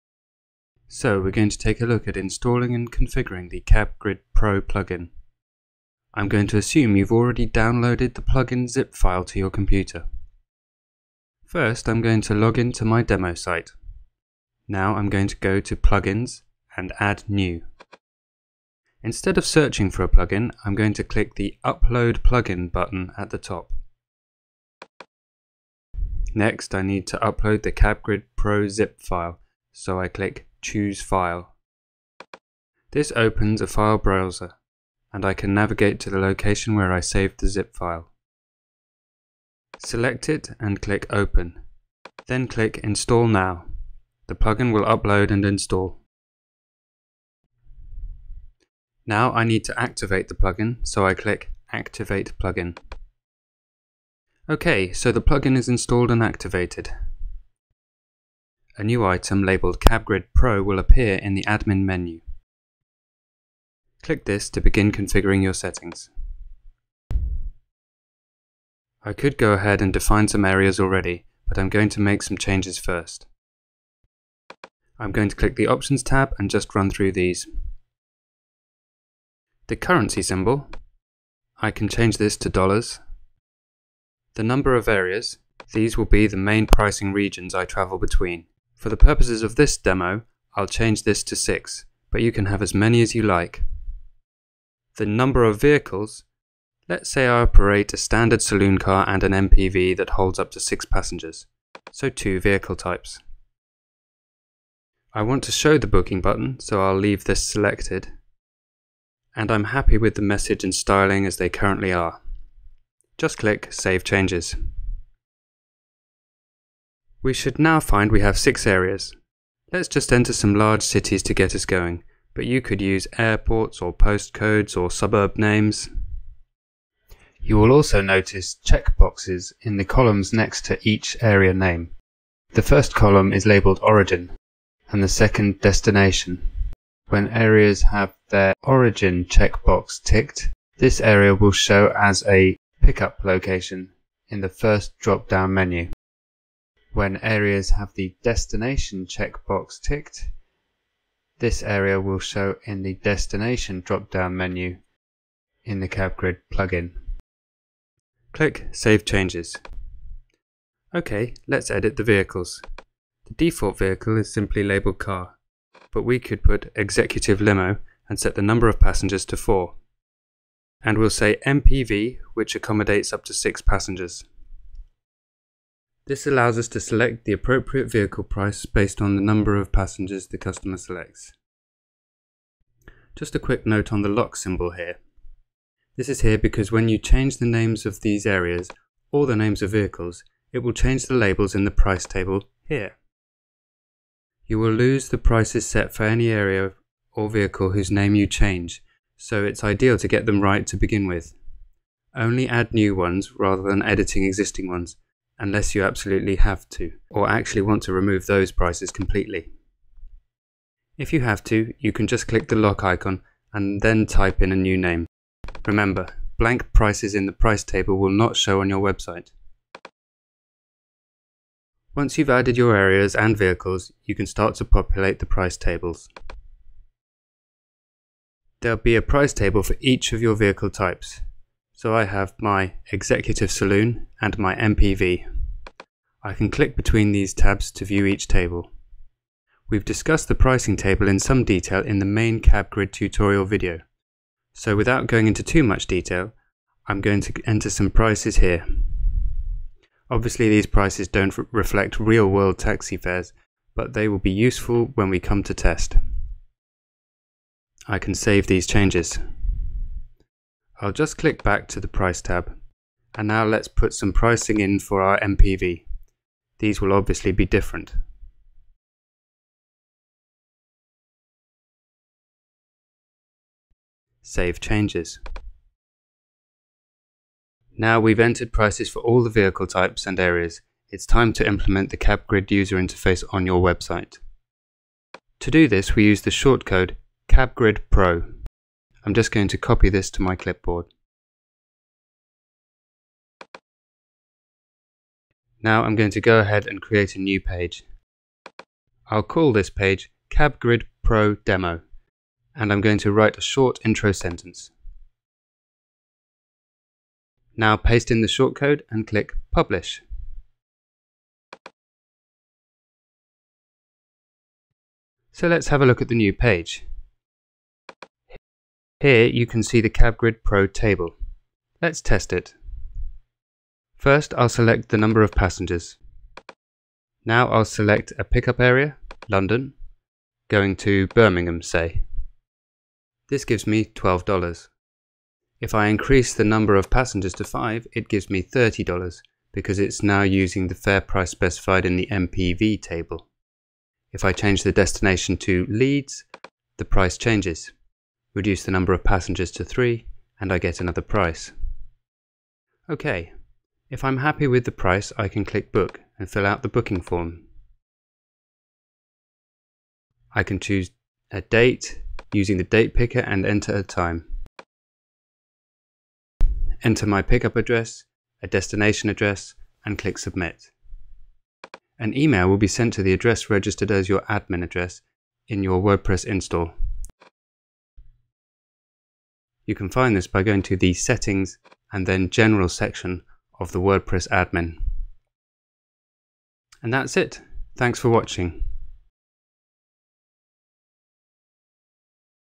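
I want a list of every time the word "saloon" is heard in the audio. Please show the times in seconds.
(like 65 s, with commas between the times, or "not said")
98 s, 233 s.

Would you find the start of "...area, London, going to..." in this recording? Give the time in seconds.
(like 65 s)
328 s.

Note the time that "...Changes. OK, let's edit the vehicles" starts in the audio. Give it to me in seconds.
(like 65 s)
159 s.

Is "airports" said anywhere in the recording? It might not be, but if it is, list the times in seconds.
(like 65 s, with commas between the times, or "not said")
123 s.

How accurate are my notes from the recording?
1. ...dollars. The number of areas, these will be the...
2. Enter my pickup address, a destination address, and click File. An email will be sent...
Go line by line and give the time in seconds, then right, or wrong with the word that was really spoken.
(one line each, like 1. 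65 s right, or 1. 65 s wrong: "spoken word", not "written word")
1. 82 s right
2. 366 s wrong: "Submit", not "File".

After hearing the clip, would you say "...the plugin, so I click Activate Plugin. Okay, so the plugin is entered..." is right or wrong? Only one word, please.
wrong.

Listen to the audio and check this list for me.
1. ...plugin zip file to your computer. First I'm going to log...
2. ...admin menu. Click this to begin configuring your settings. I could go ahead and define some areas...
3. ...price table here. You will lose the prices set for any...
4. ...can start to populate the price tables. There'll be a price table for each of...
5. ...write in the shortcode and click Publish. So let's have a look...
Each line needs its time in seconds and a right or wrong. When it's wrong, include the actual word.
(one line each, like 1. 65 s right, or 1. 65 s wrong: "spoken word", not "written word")
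1. 8 s right
2. 61 s right
3. 191 s right
4. 224 s right
5. 307 s wrong: "paste", not "write".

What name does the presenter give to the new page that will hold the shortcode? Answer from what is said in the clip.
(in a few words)
CabGrid Pro Demo.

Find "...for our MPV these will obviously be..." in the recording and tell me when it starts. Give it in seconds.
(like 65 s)
264 s.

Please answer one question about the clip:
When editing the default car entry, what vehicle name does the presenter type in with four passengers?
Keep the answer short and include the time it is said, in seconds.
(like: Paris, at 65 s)
executive limo, at 166 s.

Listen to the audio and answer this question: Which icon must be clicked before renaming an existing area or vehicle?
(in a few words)
lock icon.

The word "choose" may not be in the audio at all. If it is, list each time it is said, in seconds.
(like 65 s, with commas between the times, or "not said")
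30 s, 360 s.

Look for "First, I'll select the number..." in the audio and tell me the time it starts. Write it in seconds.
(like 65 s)
324 s.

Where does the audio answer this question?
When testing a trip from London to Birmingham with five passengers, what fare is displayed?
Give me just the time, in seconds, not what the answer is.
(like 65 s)
338 s.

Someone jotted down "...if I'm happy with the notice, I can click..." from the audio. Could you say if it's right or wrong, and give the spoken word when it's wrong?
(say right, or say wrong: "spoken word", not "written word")
wrong: "price", not "notice".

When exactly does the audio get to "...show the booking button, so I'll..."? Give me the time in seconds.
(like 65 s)
105 s.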